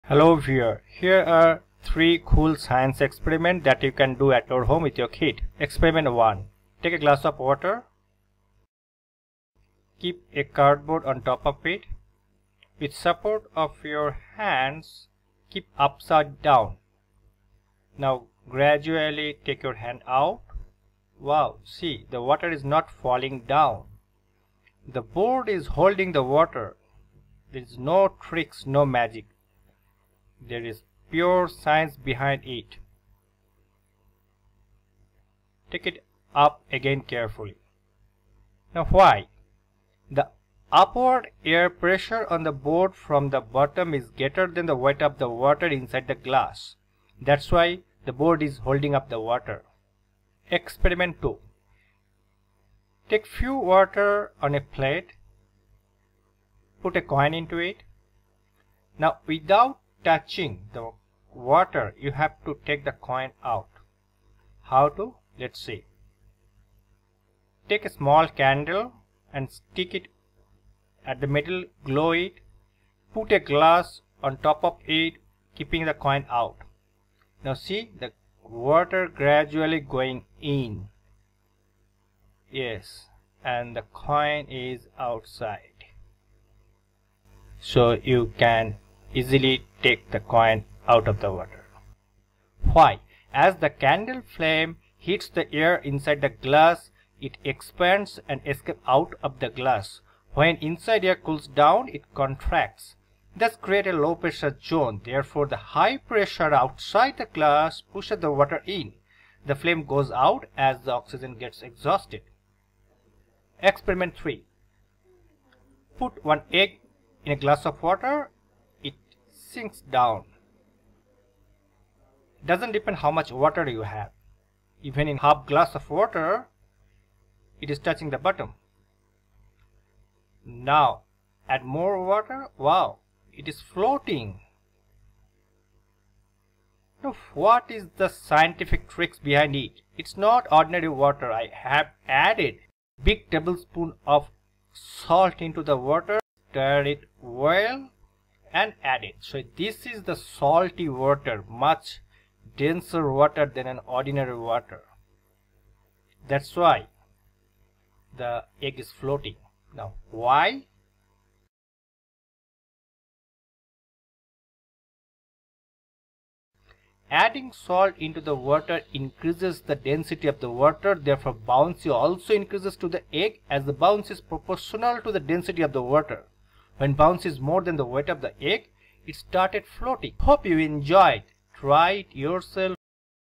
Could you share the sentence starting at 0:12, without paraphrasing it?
With support of your hands, keep upside down.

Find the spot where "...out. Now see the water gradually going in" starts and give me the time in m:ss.
1:16.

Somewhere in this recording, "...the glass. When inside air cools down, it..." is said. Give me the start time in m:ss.
1:39.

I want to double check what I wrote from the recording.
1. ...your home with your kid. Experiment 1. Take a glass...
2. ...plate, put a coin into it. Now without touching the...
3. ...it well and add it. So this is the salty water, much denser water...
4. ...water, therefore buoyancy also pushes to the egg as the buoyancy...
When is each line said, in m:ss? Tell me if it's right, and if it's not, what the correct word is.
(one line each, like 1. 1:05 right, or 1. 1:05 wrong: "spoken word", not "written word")
1. 0:04 right
2. 0:54 right
3. 2:26 right
4. 2:50 wrong: "increases", not "pushes".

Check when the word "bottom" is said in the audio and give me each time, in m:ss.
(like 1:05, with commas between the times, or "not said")
0:43, 2:08.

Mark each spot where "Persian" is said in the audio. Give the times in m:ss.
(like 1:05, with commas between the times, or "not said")
not said.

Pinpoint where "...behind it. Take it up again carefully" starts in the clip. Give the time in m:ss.
0:31.